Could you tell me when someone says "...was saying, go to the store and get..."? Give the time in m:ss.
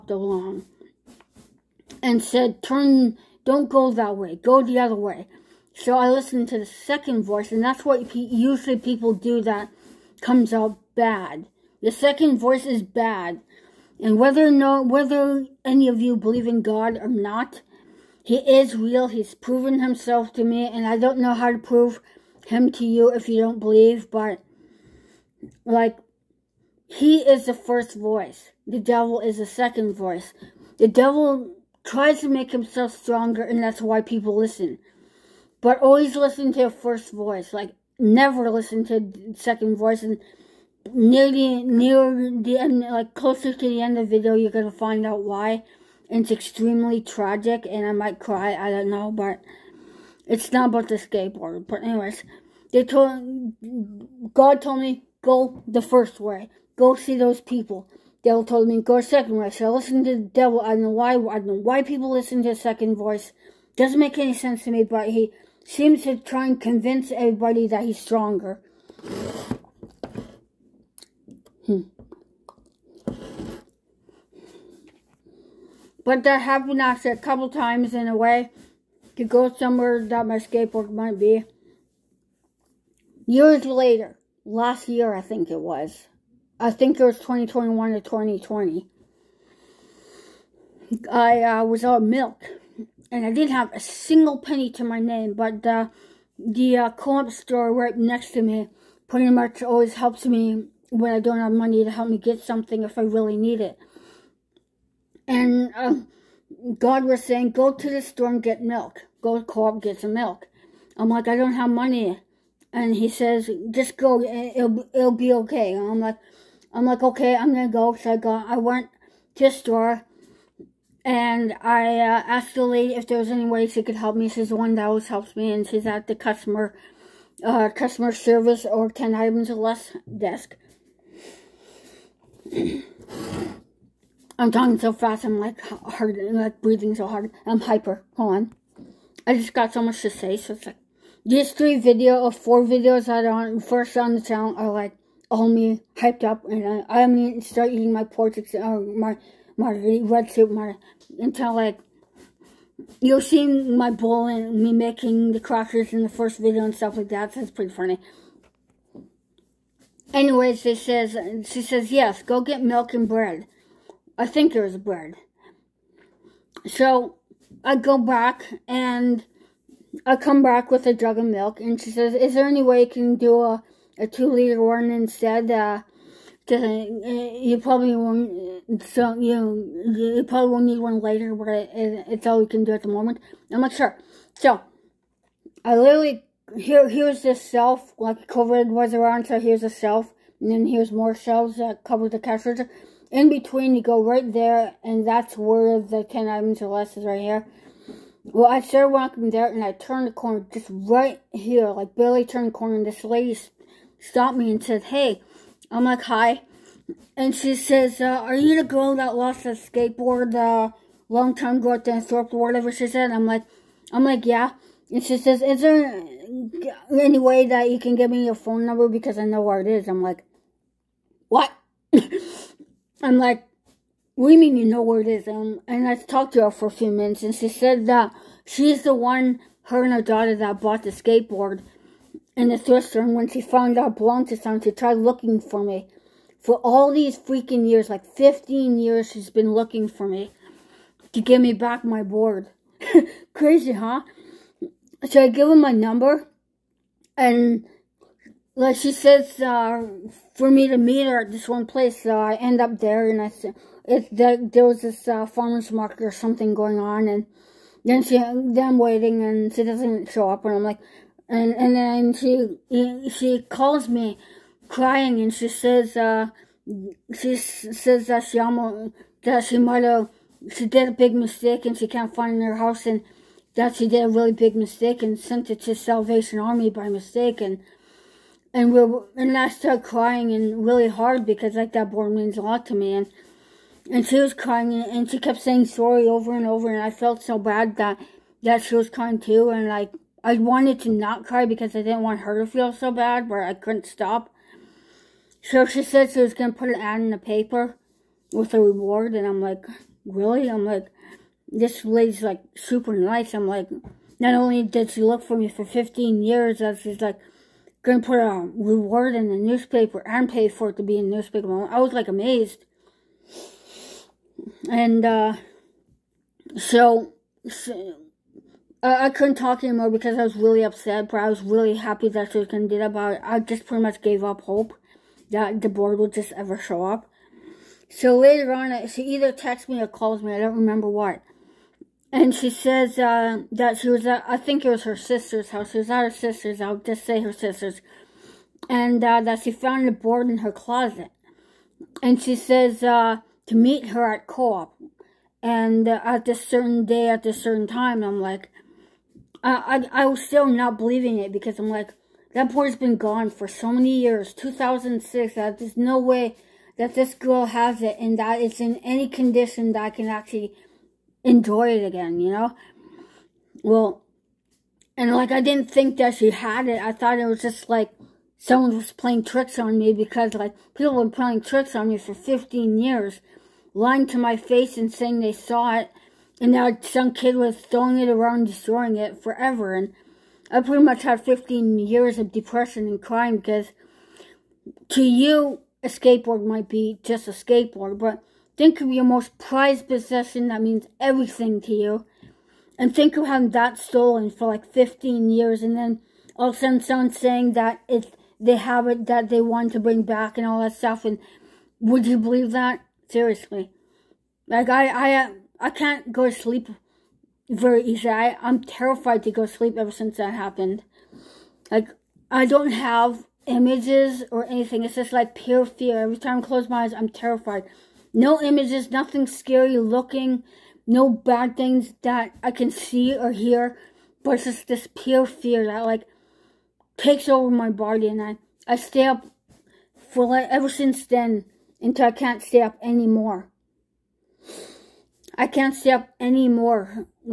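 1:47.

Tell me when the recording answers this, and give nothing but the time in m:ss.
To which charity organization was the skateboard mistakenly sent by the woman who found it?
4:35.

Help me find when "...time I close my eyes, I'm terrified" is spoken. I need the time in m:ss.
6:56.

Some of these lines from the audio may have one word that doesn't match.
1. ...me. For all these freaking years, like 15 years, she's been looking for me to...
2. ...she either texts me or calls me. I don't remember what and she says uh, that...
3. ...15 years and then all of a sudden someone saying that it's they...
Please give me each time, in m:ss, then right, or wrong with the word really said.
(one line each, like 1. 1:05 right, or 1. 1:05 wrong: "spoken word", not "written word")
1. 3:55 right
2. 5:28 right
3. 6:34 right.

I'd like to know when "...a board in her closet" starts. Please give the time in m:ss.
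5:39.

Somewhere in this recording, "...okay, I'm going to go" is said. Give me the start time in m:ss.
1:57.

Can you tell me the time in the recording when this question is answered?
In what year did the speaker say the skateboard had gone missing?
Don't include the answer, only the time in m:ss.
5:54.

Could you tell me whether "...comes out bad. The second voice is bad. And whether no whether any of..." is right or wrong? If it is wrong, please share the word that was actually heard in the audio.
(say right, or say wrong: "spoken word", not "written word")
right.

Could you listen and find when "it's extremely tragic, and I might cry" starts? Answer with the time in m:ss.
0:46.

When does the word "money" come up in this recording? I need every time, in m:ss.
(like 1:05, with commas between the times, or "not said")
1:41, 1:51.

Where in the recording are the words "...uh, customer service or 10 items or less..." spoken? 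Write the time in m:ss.
2:07.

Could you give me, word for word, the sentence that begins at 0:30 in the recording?
The devil tries to make himself stronger, and that's why people listen.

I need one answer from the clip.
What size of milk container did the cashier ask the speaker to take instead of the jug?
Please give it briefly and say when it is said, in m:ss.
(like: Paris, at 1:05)
Two liter, at 2:54.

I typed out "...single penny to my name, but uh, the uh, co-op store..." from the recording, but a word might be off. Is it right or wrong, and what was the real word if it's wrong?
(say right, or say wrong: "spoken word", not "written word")
right.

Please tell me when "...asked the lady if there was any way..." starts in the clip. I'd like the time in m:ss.
2:02.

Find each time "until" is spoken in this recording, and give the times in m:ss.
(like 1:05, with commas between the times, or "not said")
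2:31, 7:11.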